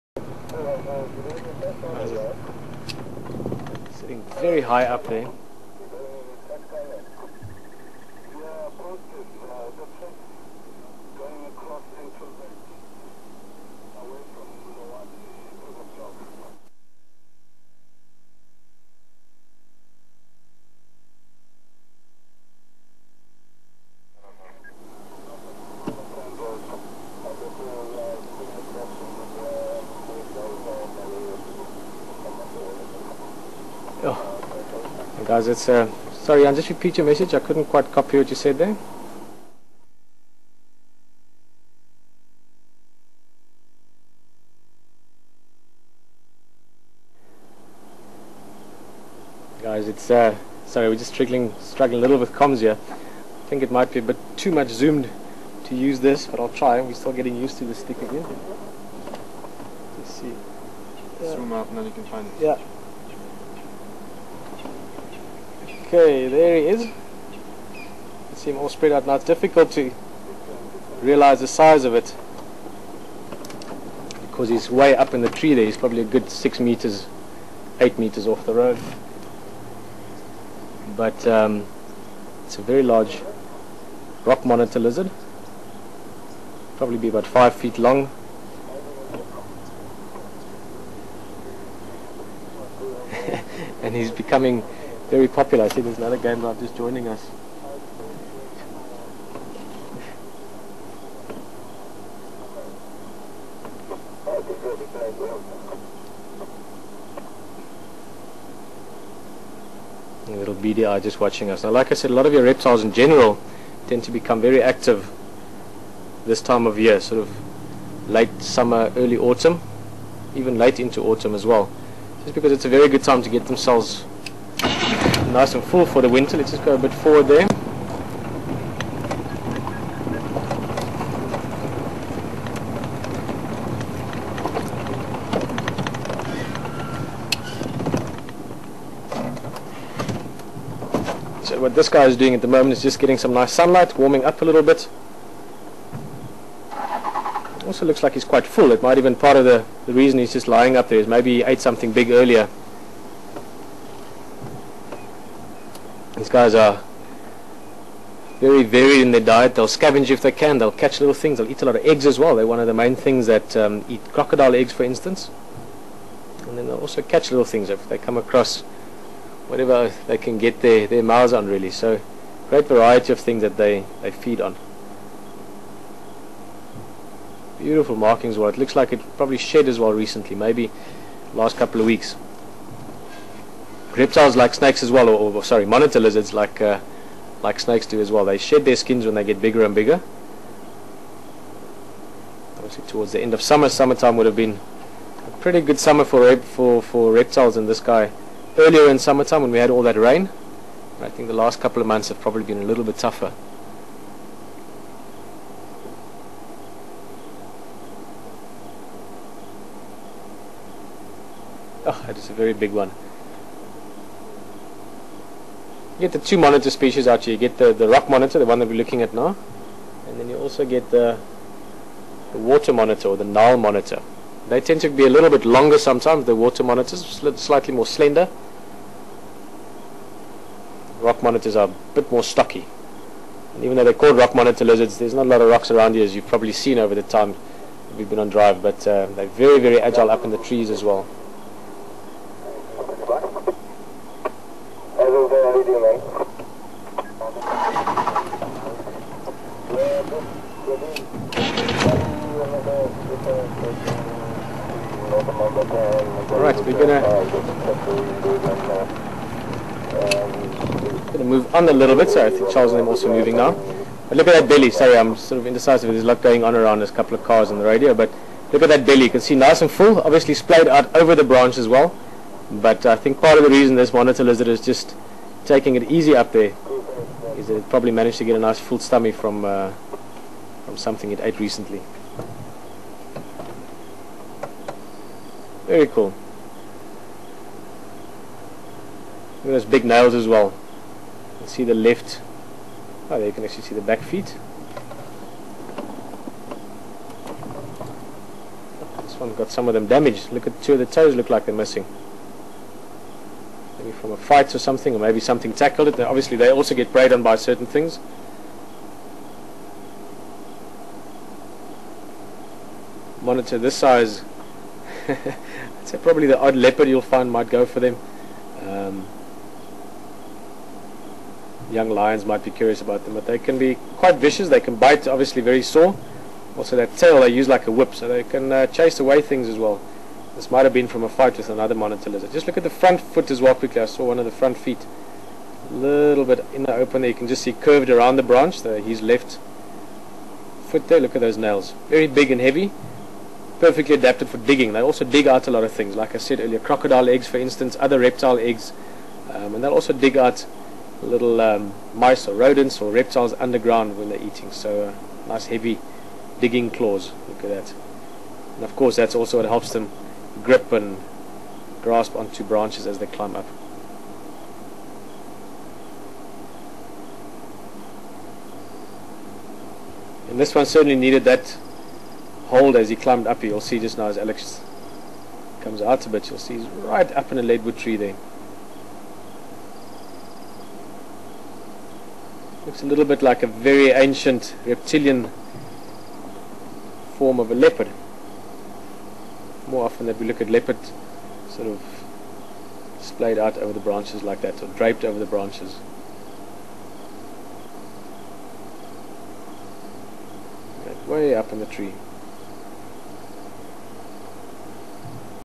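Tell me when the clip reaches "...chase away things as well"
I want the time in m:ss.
5:28.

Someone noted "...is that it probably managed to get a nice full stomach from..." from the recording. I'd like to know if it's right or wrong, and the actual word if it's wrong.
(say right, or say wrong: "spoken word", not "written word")
right.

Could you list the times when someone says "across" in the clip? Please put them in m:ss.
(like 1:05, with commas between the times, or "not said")
0:11, 2:48.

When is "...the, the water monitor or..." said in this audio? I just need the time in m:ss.
3:40.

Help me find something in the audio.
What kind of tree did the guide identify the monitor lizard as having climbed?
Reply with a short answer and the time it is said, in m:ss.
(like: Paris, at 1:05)
Leadwood tree, at 6:17.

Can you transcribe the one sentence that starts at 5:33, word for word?
I saw one of the front feet a little bit in the open there.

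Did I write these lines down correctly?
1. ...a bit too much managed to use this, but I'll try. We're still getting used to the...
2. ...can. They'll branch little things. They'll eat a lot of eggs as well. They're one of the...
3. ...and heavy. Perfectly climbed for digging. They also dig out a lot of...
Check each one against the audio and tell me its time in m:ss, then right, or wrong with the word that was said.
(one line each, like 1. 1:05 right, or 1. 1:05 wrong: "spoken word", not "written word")
1. 0:53 wrong: "zoomed", not "managed"
2. 2:40 wrong: "catch", not "branch"
3. 5:42 wrong: "adapted", not "climbed".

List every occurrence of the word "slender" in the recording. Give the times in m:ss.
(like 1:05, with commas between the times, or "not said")
3:47.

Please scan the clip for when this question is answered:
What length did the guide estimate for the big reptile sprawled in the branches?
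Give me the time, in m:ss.
1:27.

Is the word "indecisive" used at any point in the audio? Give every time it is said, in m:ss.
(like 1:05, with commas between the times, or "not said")
4:25.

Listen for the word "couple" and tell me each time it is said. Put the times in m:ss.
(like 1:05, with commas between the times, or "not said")
3:01, 3:21, 4:26.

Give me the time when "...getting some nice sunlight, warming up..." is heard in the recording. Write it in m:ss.
2:22.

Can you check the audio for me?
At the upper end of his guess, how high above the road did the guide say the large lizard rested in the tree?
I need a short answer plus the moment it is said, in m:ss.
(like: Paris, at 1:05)
8 meters, at 1:17.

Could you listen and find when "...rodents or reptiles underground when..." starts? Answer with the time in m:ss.
5:52.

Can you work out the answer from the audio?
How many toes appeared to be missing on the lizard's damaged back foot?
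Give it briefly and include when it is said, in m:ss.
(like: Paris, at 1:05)
2, at 5:00.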